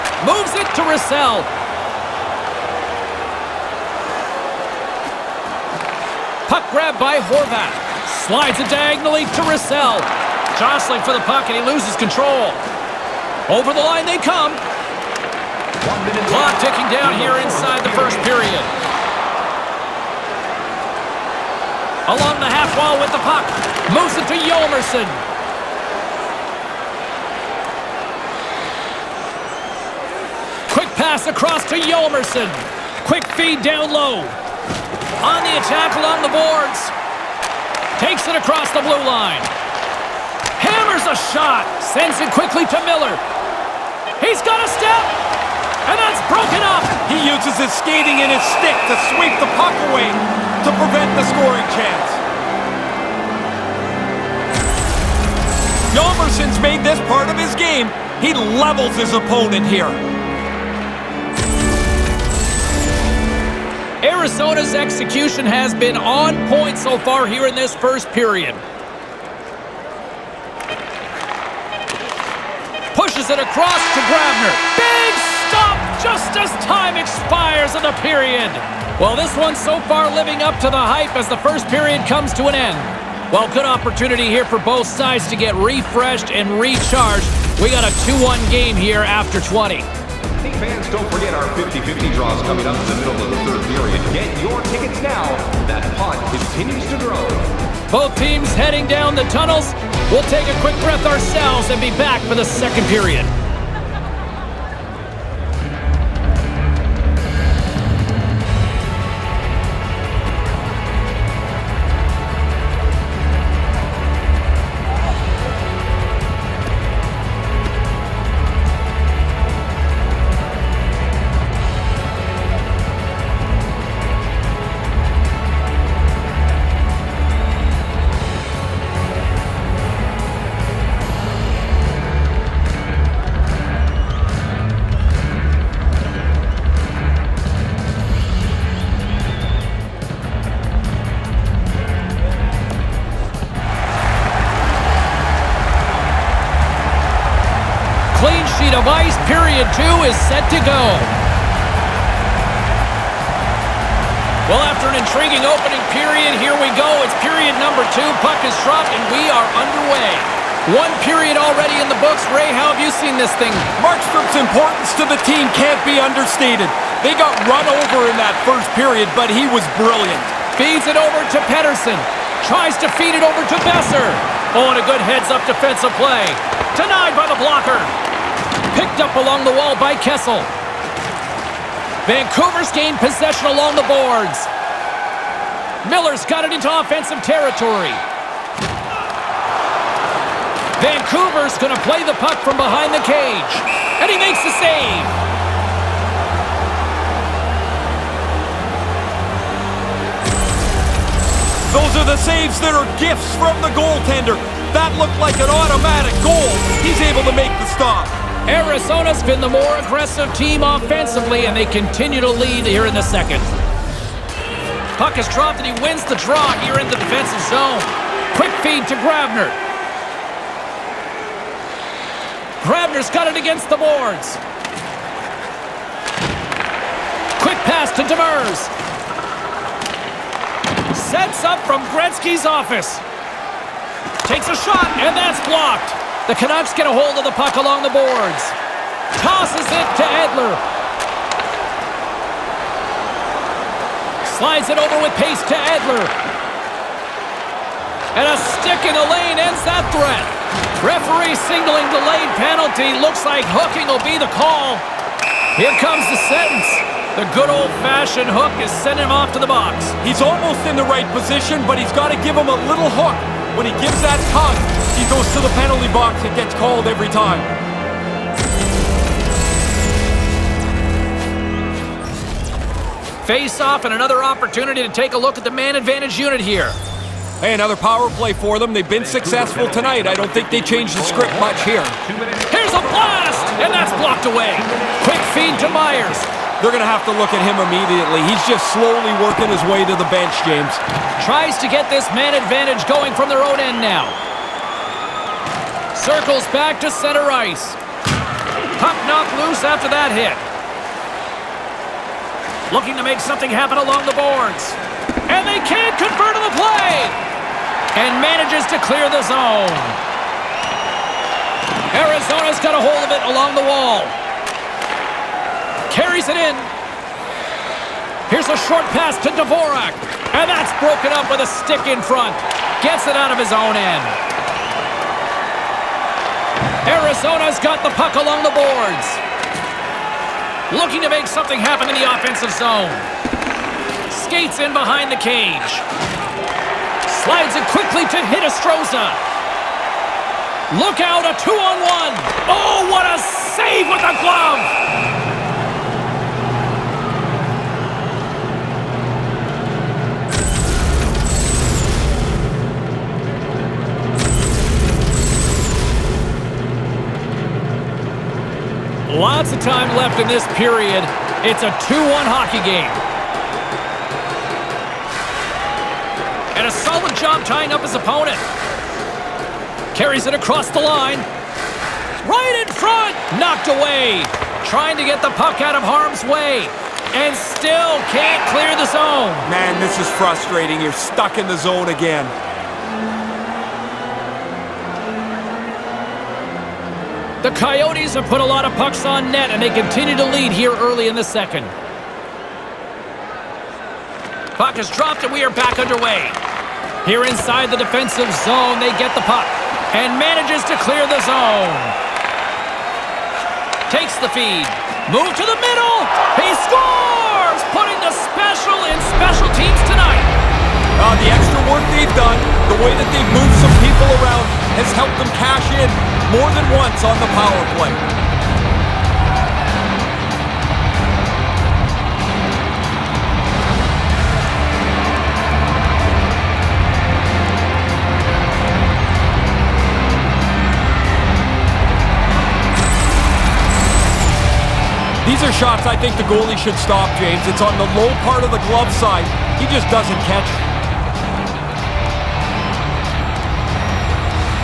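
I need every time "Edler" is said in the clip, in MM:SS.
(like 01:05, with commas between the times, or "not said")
04:00, 04:05.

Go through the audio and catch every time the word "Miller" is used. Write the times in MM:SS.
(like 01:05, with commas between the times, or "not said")
00:42, 03:05.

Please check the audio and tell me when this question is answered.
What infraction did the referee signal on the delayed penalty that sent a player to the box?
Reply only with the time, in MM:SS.
04:13.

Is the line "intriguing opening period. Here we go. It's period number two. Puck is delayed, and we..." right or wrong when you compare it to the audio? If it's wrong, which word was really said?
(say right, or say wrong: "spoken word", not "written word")
wrong: "dropped", not "delayed".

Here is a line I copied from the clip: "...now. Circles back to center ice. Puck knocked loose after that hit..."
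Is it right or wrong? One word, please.
right.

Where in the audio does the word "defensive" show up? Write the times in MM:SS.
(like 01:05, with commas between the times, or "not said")
02:55, 03:36, 06:37.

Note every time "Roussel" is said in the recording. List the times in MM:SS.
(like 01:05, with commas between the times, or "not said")
00:00, 00:09.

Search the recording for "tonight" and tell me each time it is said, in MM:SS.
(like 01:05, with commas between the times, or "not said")
04:39, 06:49.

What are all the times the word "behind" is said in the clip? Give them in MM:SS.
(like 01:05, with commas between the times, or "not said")
03:12, 05:34.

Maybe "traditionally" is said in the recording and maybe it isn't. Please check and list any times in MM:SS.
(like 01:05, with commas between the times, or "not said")
not said.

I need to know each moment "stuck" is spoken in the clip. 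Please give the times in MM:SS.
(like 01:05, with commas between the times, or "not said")
06:20.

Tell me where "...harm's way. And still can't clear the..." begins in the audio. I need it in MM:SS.
06:15.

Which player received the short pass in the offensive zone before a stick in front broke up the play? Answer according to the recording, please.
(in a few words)
Dvorak.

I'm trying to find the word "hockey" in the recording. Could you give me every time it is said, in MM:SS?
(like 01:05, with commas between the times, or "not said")
06:02.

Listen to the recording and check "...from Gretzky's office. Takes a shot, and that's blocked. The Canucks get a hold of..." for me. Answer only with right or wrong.
right.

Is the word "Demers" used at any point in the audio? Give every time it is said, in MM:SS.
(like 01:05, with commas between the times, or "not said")
03:48.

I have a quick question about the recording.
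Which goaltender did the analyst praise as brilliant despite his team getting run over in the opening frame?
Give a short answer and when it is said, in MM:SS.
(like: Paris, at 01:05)
Markstrom, at 02:43.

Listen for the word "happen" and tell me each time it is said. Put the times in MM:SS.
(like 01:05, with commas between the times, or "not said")
05:03, 05:31.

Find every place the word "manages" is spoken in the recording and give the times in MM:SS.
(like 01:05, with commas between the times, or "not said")
05:08, 06:40.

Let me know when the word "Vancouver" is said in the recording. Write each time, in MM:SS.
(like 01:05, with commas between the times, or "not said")
03:02, 03:10.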